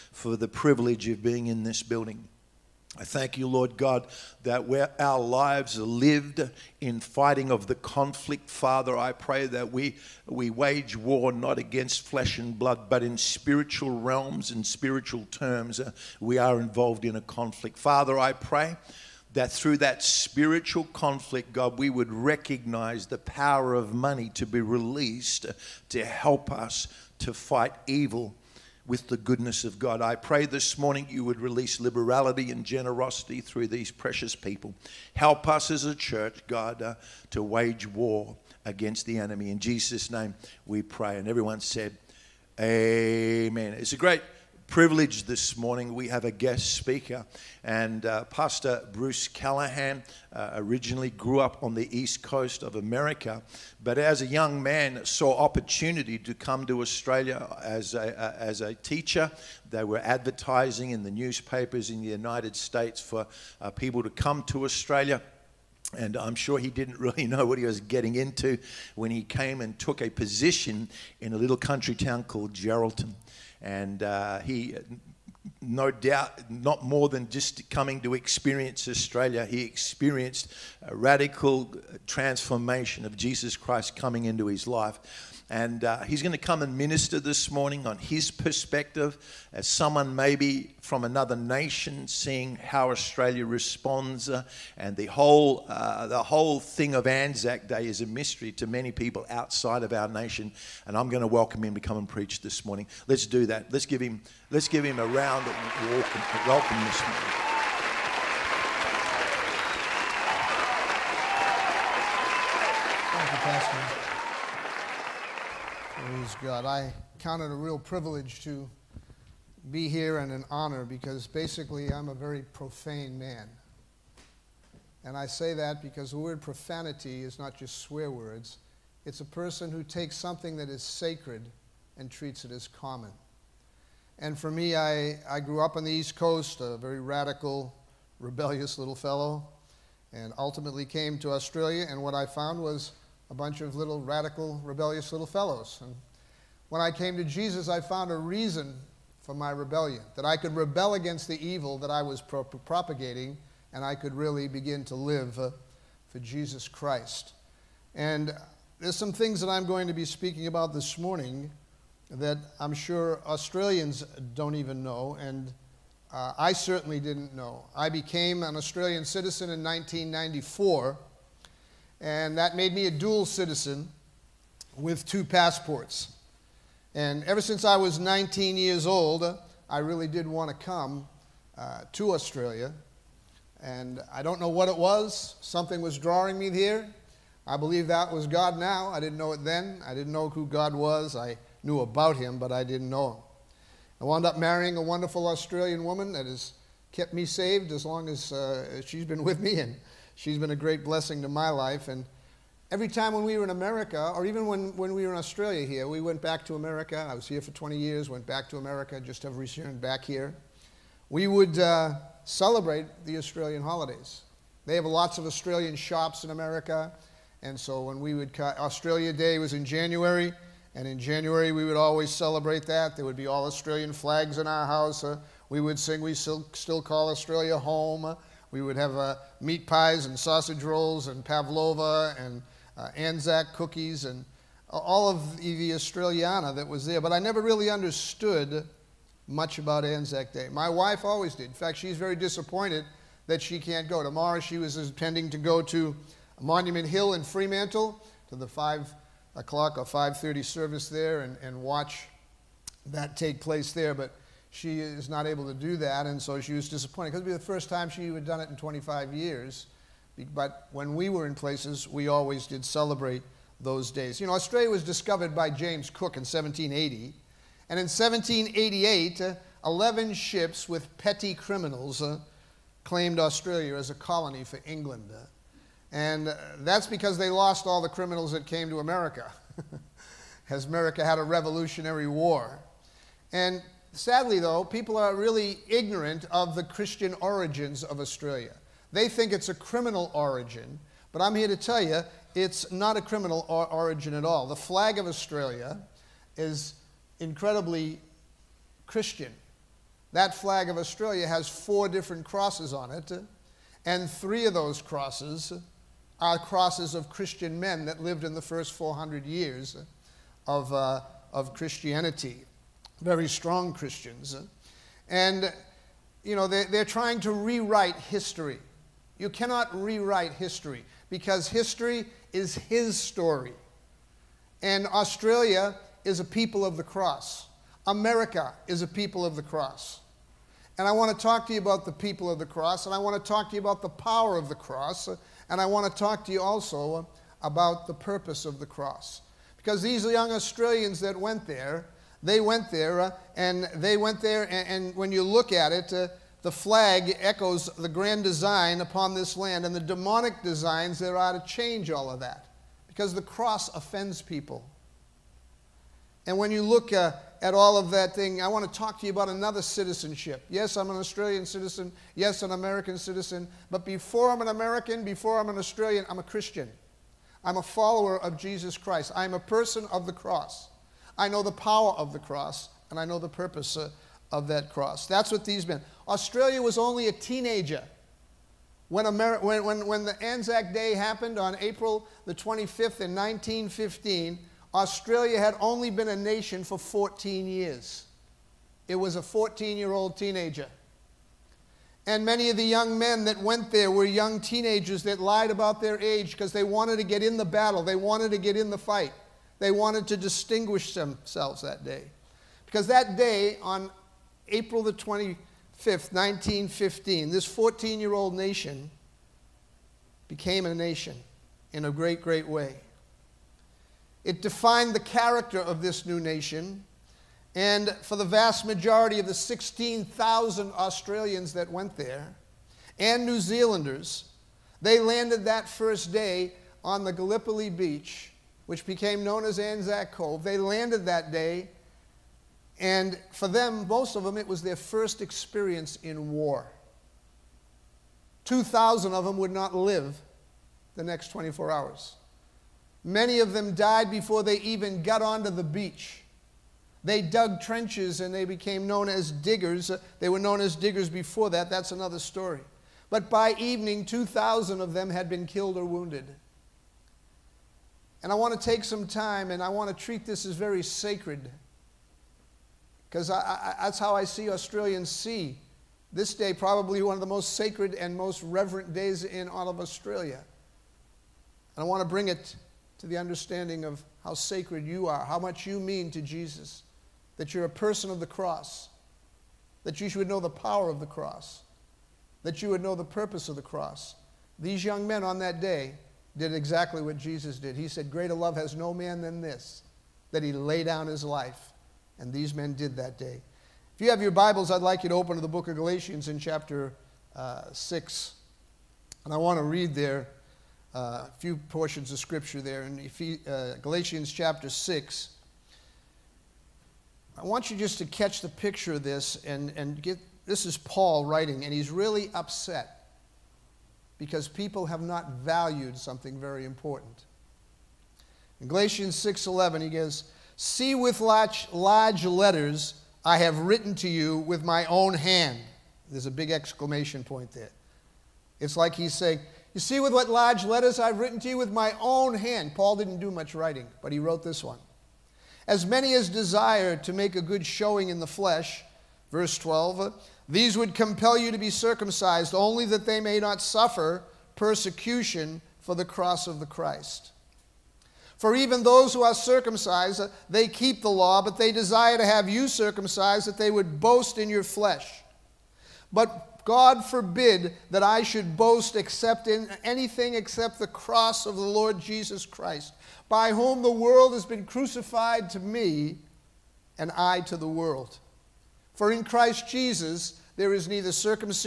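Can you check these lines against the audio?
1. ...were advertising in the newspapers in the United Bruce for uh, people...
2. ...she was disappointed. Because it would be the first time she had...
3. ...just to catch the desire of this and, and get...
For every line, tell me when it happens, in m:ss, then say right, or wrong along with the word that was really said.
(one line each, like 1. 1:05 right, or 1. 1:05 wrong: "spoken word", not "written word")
1. 0:59 wrong: "States", not "Bruce"
2. 4:16 right
3. 8:27 wrong: "picture", not "desire".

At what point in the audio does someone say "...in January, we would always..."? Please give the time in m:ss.
3:40.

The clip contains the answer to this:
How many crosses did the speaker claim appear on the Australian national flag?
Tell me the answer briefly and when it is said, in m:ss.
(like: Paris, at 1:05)
4, at 5:01.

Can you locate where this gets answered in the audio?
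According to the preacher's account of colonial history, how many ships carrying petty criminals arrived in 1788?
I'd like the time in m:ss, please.
4:29.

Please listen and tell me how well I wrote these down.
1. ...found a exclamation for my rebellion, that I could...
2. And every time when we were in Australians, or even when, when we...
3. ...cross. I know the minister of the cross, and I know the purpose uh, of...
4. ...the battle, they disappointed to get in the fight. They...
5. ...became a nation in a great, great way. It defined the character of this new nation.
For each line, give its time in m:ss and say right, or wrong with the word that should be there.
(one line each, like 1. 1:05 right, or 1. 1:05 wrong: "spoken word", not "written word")
1. 2:27 wrong: "reason", not "exclamation"
2. 3:21 wrong: "America", not "Australians"
3. 6:10 wrong: "power", not "minister"
4. 6:37 wrong: "wanted", not "disappointed"
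5. 6:50 right.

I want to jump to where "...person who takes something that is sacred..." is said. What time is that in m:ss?
2:09.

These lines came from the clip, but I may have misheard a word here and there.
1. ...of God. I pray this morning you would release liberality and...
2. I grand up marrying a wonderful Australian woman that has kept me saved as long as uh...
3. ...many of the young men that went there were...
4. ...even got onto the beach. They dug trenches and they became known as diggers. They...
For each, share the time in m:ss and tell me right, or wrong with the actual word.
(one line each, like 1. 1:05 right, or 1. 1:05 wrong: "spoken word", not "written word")
1. 0:29 right
2. 3:14 wrong: "wound", not "grand"
3. 6:32 right
4. 7:24 right.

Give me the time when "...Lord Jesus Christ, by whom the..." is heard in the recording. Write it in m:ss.
9:21.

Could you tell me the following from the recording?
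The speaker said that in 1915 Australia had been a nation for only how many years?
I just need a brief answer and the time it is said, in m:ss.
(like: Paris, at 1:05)
14, at 6:26.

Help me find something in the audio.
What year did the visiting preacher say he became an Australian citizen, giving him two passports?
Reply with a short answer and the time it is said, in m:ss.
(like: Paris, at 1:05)
1994, at 2:49.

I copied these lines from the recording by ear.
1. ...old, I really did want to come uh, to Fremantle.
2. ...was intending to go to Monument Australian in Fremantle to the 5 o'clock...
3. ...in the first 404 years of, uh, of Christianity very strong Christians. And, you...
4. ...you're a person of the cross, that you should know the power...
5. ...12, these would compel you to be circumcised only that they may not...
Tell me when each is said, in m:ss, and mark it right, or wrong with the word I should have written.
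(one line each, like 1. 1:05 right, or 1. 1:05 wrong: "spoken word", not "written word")
1. 2:58 wrong: "Australia", not "Fremantle"
2. 4:04 wrong: "Hill", not "Australian"
3. 5:08 wrong: "400", not "404"
4. 7:57 right
5. 8:59 right.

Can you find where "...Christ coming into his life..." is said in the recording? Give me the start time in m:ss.
1:23.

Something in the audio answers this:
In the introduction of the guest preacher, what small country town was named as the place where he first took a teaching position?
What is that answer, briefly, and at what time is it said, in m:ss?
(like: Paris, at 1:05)
Geraldton, at 1:12.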